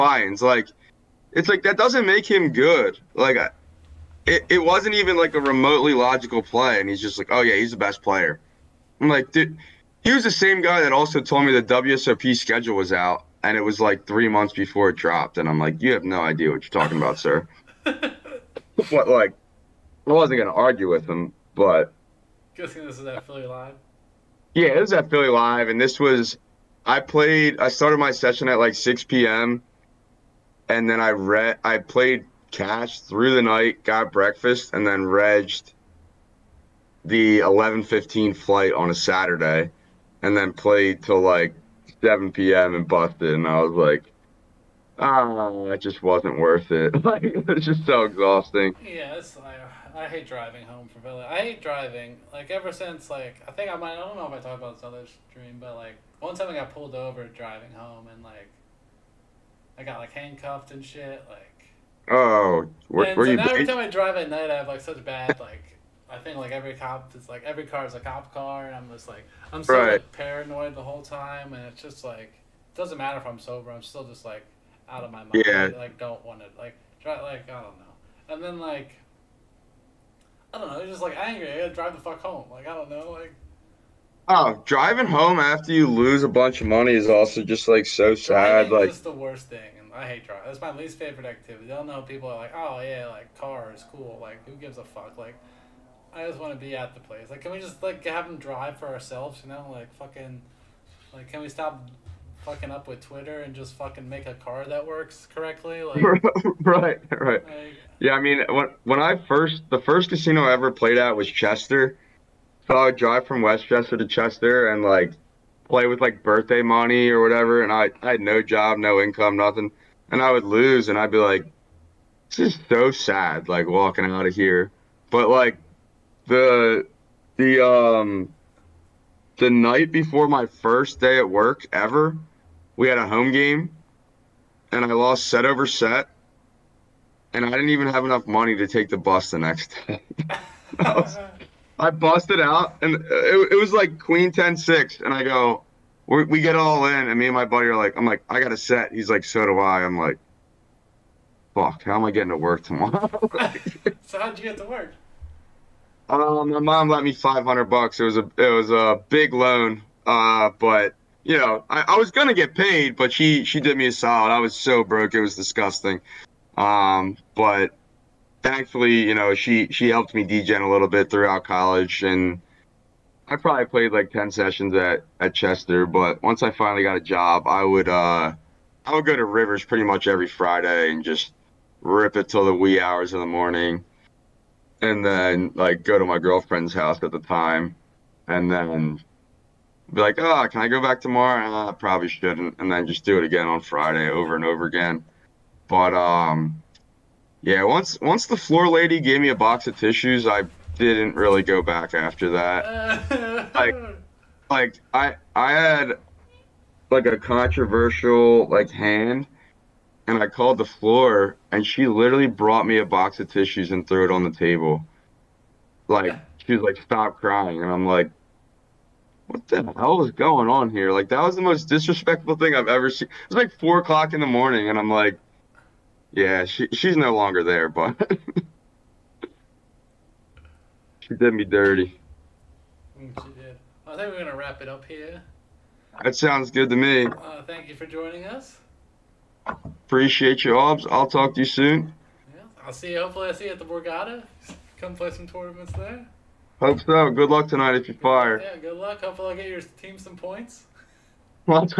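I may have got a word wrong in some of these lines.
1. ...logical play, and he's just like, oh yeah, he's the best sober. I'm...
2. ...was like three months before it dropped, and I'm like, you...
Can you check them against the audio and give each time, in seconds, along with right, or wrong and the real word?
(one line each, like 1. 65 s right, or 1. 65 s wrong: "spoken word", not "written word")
1. 5 s wrong: "player", not "sober"
2. 13 s right.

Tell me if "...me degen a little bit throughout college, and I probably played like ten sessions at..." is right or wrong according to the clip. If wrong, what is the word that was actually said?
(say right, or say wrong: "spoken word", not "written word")
right.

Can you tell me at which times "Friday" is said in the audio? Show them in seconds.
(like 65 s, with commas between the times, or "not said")
180 s, 193 s.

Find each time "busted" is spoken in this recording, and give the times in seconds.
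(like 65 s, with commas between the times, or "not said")
42 s, 141 s.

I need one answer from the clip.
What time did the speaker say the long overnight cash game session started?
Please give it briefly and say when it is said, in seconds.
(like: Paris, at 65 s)
6 p.m., at 28 s.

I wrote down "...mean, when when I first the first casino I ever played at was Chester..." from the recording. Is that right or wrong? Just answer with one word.
right.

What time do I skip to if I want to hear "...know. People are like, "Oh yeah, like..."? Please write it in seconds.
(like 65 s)
91 s.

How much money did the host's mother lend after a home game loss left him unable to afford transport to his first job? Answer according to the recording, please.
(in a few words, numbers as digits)
$500.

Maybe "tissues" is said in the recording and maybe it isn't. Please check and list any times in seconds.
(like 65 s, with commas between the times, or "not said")
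199 s, 213 s.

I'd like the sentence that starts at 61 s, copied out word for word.
Like oh, where, and where so you?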